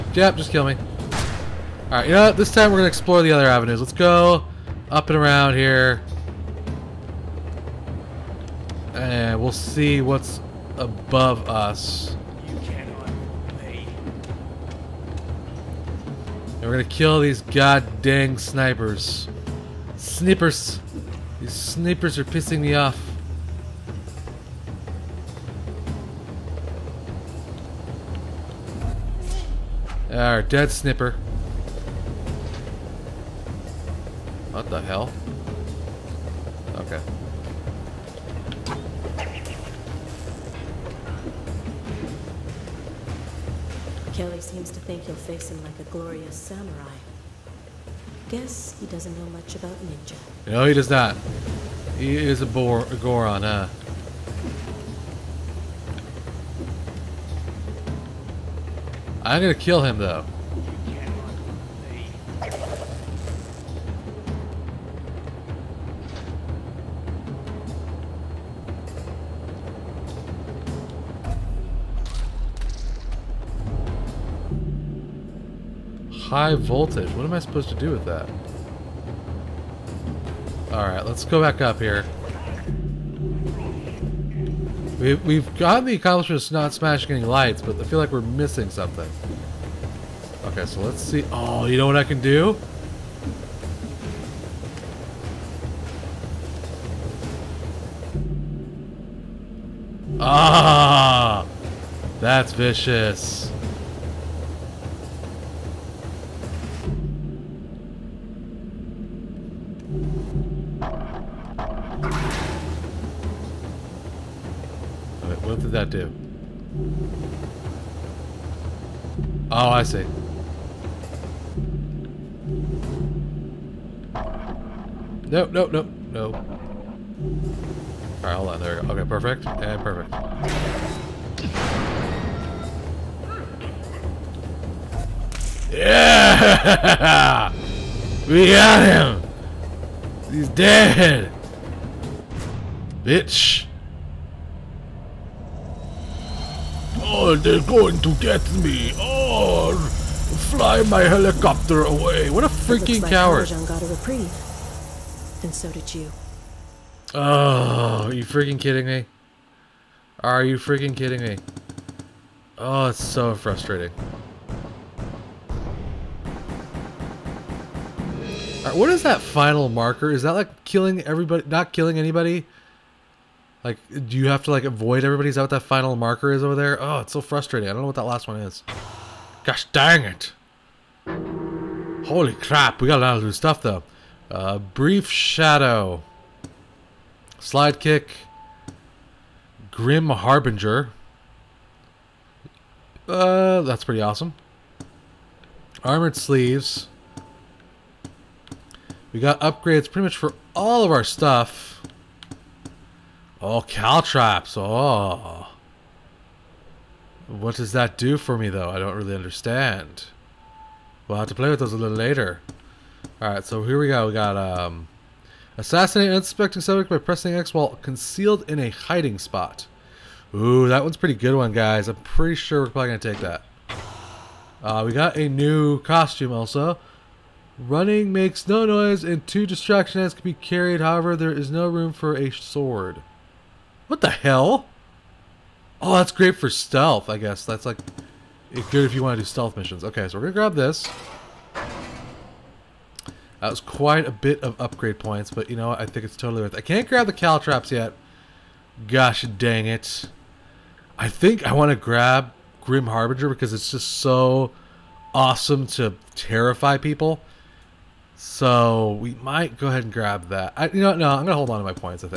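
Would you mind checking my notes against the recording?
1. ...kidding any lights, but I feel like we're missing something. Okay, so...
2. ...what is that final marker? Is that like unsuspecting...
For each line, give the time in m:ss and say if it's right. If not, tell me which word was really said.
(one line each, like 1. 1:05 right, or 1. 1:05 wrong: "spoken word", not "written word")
1. 1:26 wrong: "smashing", not "kidding"
2. 2:48 wrong: "killing", not "unsuspecting".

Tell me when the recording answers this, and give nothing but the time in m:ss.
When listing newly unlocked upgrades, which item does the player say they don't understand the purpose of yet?
3:23.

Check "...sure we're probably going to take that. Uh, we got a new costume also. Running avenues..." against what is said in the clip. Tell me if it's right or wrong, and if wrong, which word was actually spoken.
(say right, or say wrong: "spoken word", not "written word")
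wrong: "makes", not "avenues".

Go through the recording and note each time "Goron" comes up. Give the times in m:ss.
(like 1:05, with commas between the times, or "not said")
0:52.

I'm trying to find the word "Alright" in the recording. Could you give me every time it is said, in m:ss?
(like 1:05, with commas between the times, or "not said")
0:01, 1:20, 2:08, 3:33.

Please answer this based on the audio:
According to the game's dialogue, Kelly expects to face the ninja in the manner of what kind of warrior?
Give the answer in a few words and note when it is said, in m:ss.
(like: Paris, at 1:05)
Glorious samurai, at 0:45.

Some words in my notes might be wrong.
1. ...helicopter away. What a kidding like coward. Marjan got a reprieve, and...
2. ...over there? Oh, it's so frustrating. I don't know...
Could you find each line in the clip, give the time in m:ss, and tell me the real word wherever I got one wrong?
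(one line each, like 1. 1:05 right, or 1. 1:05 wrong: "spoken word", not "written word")
1. 2:31 wrong: "freaking", not "kidding"
2. 2:56 right.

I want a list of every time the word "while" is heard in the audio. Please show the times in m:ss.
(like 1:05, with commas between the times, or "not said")
3:37.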